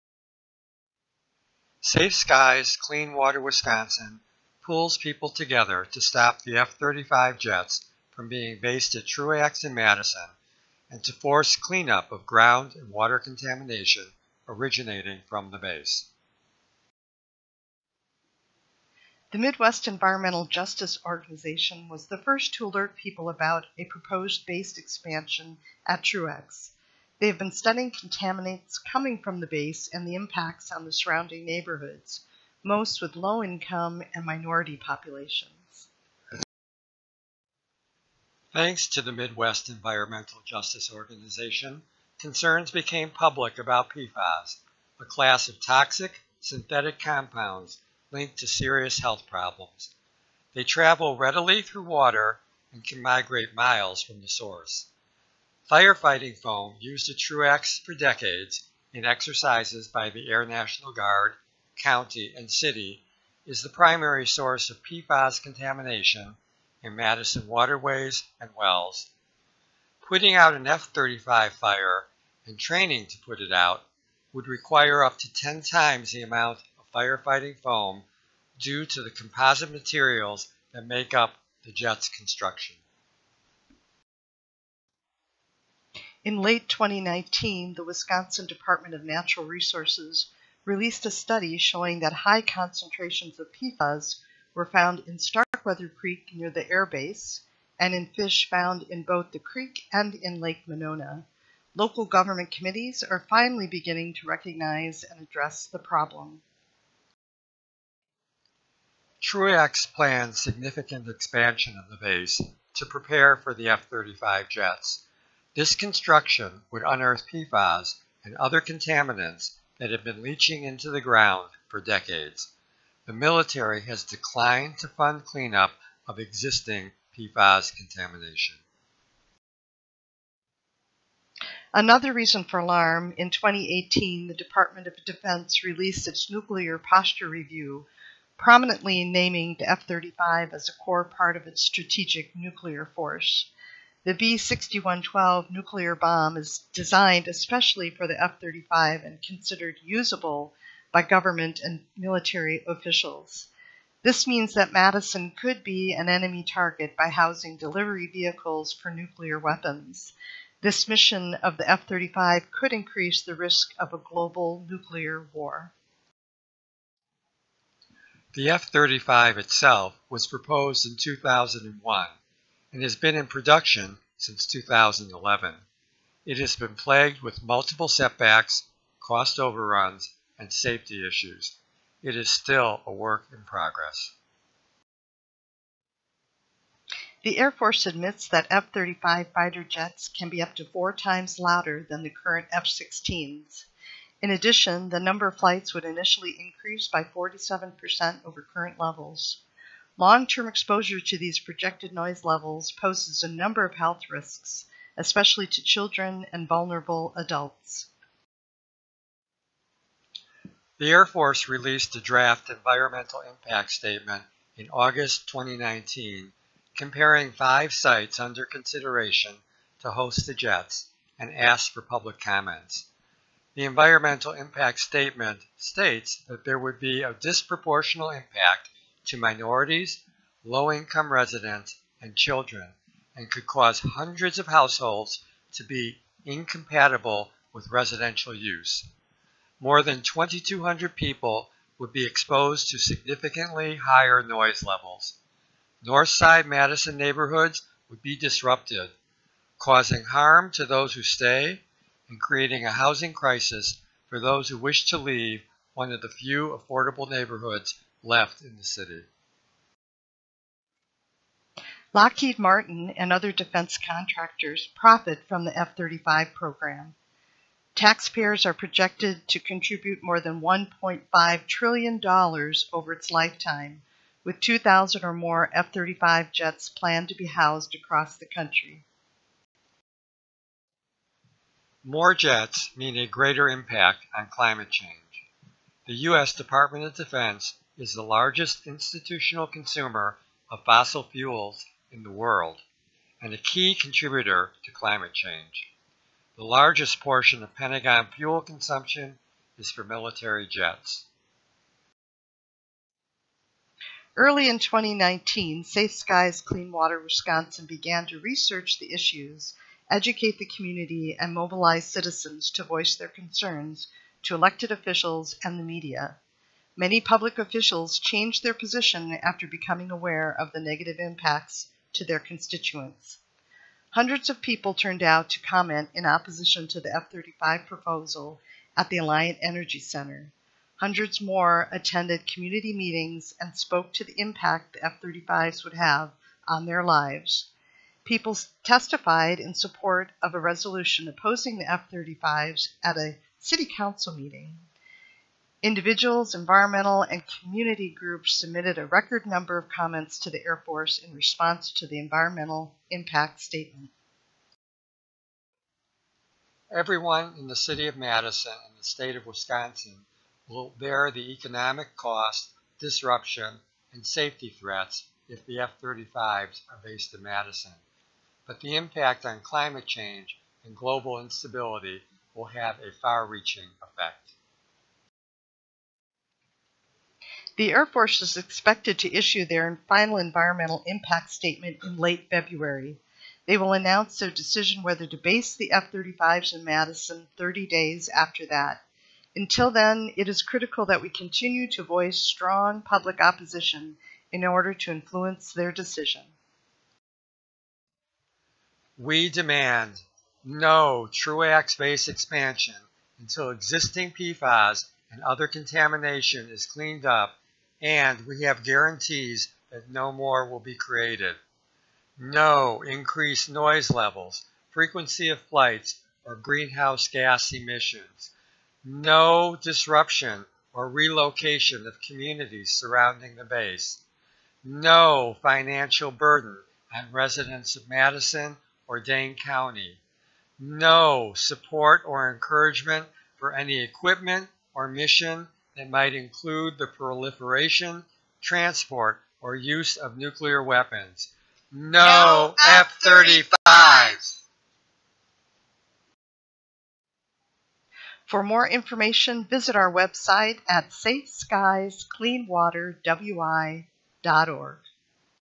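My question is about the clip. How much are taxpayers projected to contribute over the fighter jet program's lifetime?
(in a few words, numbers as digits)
$1.5 trillion.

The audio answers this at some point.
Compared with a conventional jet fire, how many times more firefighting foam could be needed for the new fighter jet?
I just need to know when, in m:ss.
1:15.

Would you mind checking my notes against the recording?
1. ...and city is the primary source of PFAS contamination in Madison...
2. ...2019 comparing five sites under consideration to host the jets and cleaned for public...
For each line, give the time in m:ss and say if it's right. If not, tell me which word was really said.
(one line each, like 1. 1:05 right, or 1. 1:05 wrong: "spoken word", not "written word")
1. 1:02 right
2. 3:35 wrong: "asked", not "cleaned".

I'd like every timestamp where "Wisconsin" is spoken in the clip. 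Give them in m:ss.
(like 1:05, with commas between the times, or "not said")
0:03, 1:27, 5:06, 5:59.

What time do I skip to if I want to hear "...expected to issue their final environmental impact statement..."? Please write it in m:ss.
6:18.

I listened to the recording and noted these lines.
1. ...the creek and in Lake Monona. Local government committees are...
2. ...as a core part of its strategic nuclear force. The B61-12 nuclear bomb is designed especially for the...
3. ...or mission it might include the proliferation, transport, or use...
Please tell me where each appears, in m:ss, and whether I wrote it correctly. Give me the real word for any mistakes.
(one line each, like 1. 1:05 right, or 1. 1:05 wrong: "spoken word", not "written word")
1. 1:39 right
2. 2:20 right
3. 7:14 right.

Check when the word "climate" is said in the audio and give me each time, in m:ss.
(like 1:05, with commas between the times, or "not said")
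4:44, 4:54, 6:09.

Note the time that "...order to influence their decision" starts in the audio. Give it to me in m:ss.
6:34.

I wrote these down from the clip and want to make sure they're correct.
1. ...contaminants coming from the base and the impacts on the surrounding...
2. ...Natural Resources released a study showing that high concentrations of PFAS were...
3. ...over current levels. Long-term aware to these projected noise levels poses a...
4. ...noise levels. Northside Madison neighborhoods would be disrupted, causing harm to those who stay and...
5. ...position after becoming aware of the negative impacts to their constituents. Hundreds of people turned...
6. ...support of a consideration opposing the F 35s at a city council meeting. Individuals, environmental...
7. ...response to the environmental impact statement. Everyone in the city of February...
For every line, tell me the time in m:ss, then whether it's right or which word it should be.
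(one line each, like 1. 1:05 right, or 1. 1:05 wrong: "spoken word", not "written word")
1. 0:27 right
2. 1:29 right
3. 3:18 wrong: "exposure", not "aware"
4. 4:04 right
5. 5:18 right
6. 5:39 wrong: "resolution", not "consideration"
7. 5:51 wrong: "Madison", not "February".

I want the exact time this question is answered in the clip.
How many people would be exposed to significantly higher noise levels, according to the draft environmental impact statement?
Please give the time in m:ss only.
3:59.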